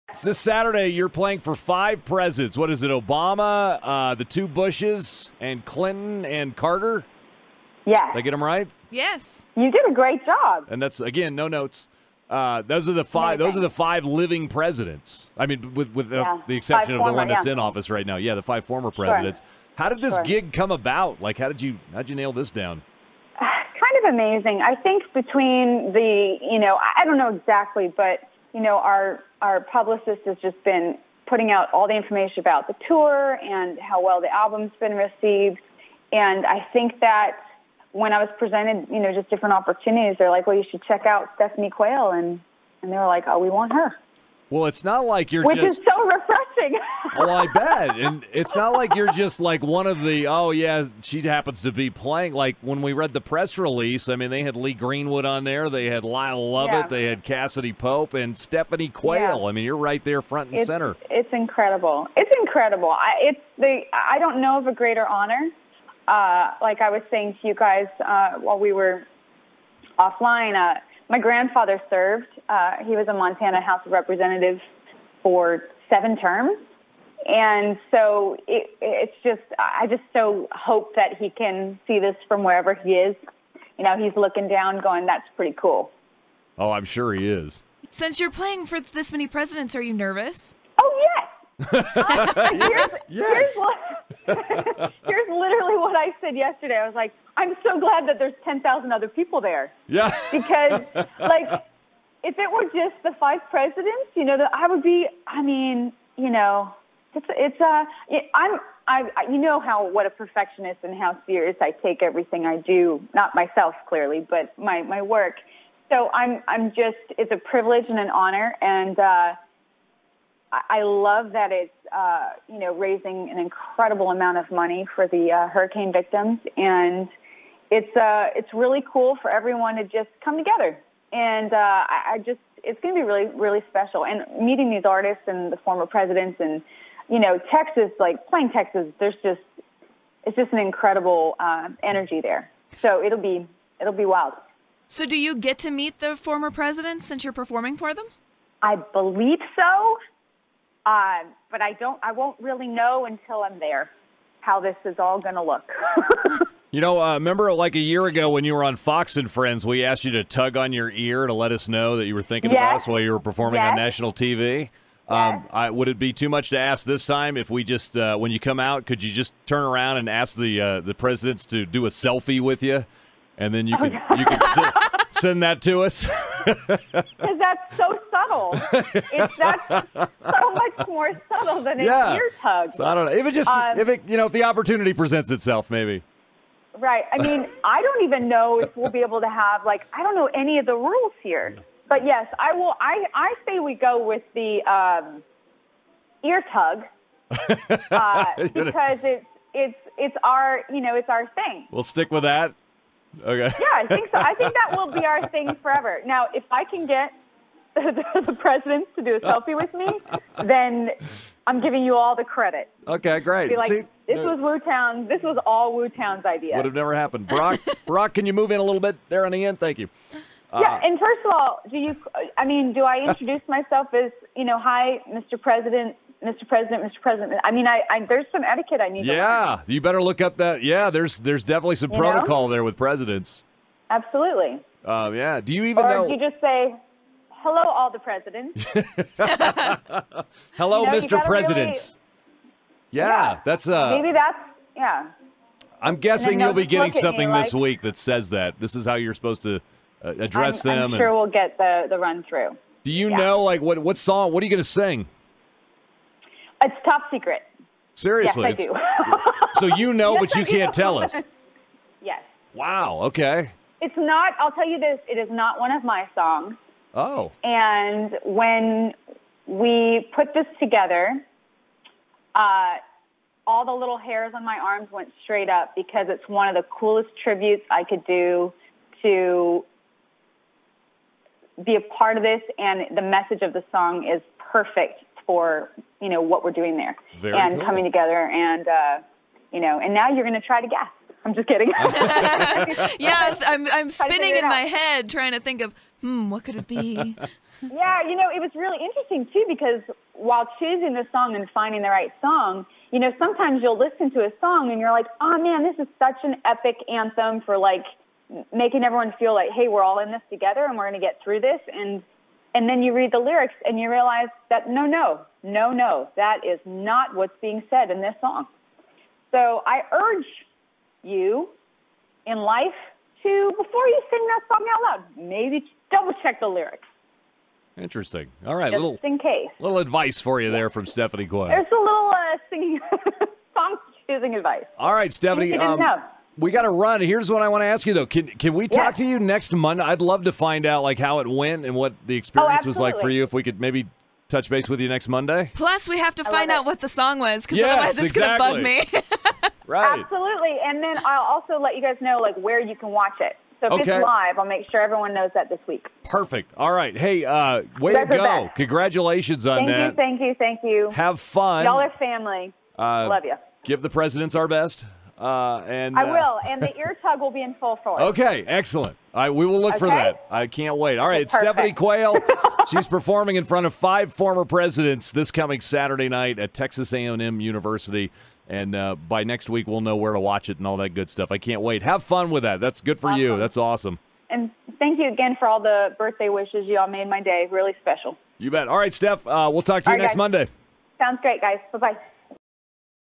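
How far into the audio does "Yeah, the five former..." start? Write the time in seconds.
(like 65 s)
18 s.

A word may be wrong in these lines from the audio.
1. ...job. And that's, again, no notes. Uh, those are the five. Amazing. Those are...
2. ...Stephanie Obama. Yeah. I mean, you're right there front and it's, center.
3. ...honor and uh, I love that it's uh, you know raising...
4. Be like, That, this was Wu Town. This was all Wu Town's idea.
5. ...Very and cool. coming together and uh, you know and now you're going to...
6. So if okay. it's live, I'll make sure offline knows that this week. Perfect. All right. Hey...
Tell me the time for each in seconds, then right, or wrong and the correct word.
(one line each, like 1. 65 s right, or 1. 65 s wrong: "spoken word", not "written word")
1. 10 s right
2. 58 s wrong: "Quayle", not "Obama"
3. 118 s right
4. 213 s wrong: "See", not "That"
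5. 287 s right
6. 353 s wrong: "everyone", not "offline".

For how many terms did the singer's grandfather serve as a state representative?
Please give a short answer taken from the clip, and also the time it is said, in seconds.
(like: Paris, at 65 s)
7, at 75 s.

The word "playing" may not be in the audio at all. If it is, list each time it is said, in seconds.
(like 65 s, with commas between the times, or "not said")
1 s, 51 s, 88 s, 138 s.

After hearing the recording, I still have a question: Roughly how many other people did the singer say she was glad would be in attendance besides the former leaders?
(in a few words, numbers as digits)
10,000.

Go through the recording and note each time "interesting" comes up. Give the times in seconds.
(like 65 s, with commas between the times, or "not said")
298 s, 327 s.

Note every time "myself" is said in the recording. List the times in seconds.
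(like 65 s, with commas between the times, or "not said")
113 s, 223 s.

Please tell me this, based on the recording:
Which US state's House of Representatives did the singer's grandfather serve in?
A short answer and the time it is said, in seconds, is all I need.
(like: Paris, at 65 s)
Montana, at 73 s.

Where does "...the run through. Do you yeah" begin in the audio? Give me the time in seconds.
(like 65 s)
251 s.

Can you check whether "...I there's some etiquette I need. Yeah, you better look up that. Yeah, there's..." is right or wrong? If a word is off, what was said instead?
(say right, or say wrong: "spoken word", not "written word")
right.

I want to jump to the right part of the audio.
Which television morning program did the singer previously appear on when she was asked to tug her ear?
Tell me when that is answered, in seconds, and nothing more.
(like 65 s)
158 s.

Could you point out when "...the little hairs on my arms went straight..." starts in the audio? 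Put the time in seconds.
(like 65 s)
273 s.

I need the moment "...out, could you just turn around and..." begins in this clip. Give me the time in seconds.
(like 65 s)
168 s.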